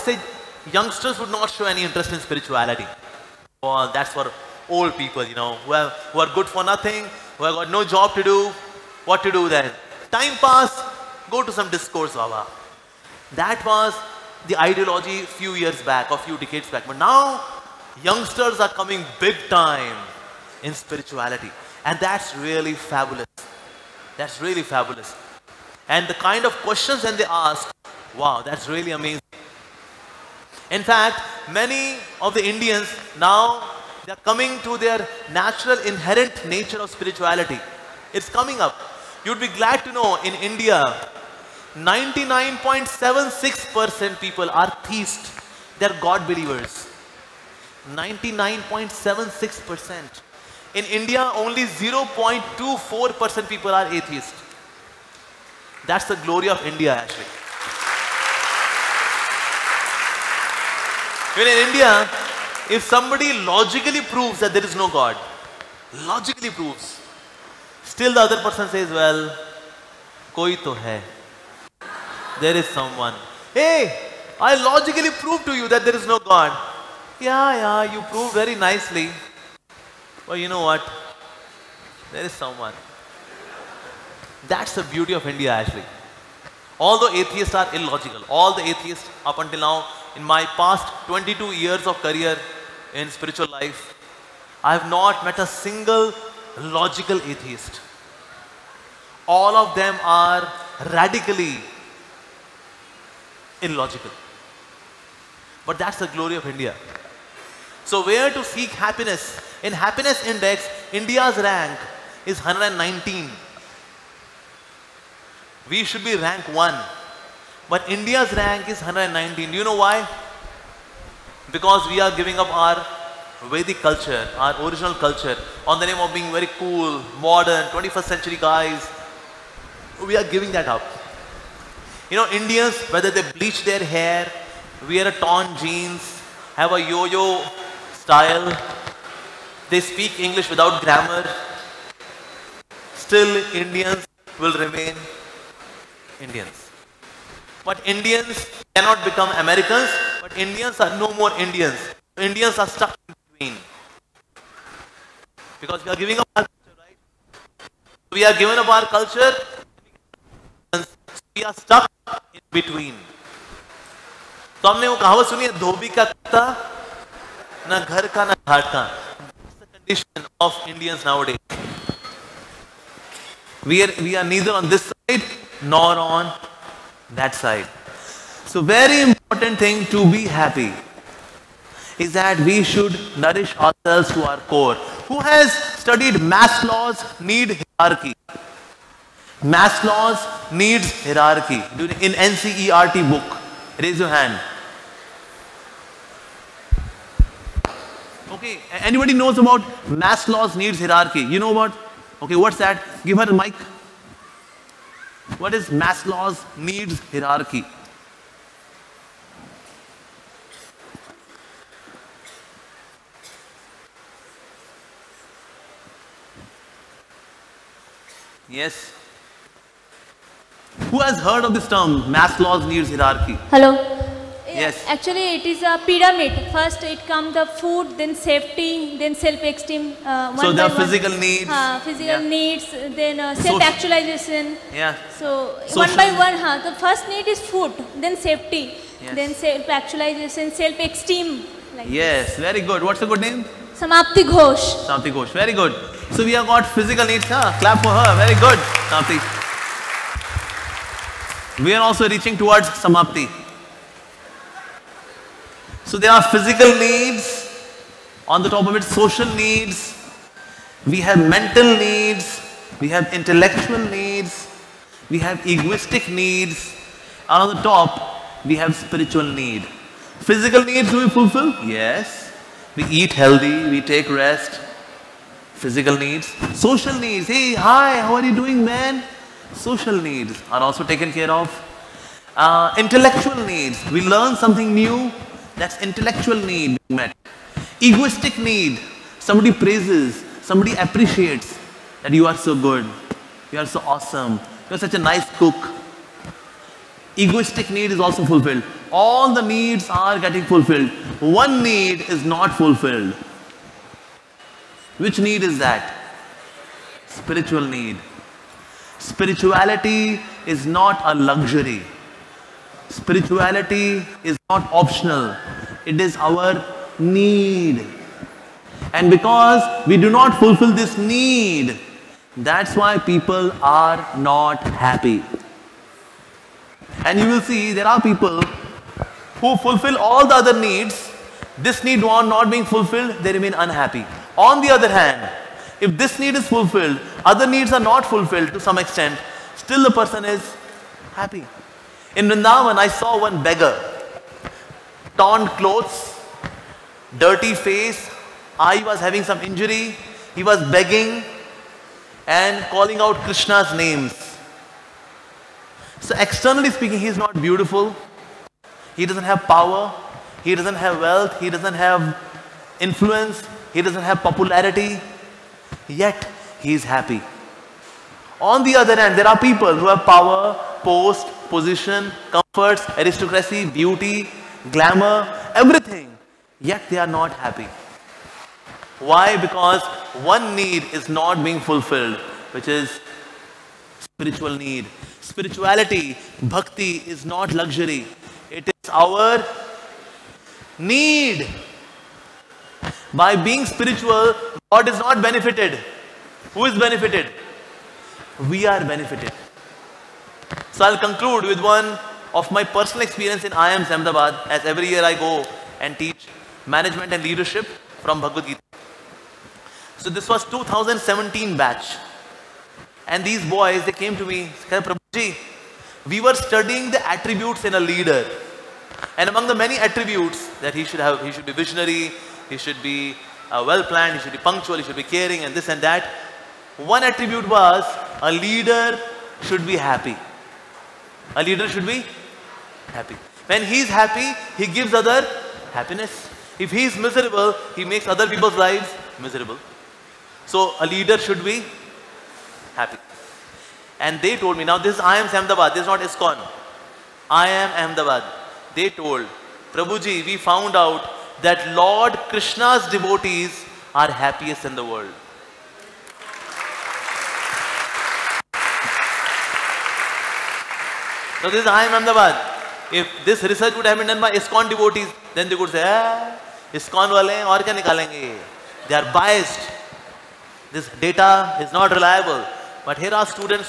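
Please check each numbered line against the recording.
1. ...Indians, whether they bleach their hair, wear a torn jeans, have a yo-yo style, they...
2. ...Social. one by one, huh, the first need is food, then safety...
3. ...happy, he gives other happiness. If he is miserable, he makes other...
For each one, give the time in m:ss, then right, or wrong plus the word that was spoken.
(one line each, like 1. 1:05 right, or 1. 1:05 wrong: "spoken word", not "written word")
1. 2:12 right
2. 3:55 right
3. 7:13 right.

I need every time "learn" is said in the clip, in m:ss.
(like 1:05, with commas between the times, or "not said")
4:44.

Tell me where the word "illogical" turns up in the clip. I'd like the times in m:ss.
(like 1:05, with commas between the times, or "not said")
1:27, 1:43.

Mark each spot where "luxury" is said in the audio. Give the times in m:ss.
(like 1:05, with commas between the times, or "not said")
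5:11, 6:27.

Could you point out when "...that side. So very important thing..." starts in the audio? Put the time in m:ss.
2:57.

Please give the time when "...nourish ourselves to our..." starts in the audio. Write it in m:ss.
3:03.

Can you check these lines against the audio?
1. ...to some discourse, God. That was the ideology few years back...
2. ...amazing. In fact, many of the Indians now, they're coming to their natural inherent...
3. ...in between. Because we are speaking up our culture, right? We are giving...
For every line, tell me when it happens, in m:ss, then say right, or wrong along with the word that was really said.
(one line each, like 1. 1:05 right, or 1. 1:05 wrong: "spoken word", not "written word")
1. 0:11 wrong: "Baba", not "God"
2. 0:28 right
3. 2:33 wrong: "giving", not "speaking".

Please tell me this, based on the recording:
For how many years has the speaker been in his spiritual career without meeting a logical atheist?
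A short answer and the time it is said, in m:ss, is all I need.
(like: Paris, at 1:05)
22, at 1:31.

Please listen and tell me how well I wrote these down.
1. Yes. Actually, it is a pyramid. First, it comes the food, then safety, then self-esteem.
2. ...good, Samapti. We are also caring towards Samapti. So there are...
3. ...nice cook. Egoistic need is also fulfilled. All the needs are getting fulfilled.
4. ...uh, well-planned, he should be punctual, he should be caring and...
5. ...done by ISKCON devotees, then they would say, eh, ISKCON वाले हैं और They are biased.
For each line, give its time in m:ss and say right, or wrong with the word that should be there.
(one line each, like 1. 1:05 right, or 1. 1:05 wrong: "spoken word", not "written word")
1. 3:44 right
2. 4:08 wrong: "reaching", not "caring"
3. 4:54 right
4. 7:03 right
5. 7:44 right.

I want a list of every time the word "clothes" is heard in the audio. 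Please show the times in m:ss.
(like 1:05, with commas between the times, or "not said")
5:45.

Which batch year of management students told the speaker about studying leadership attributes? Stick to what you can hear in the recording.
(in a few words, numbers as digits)
2017.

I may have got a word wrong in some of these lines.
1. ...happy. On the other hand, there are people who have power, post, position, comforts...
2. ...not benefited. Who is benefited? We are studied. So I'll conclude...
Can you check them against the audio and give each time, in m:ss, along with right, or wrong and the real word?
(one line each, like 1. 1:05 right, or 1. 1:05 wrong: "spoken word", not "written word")
1. 6:06 right
2. 6:34 wrong: "benefited", not "studied".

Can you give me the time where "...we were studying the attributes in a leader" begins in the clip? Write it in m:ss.
6:56.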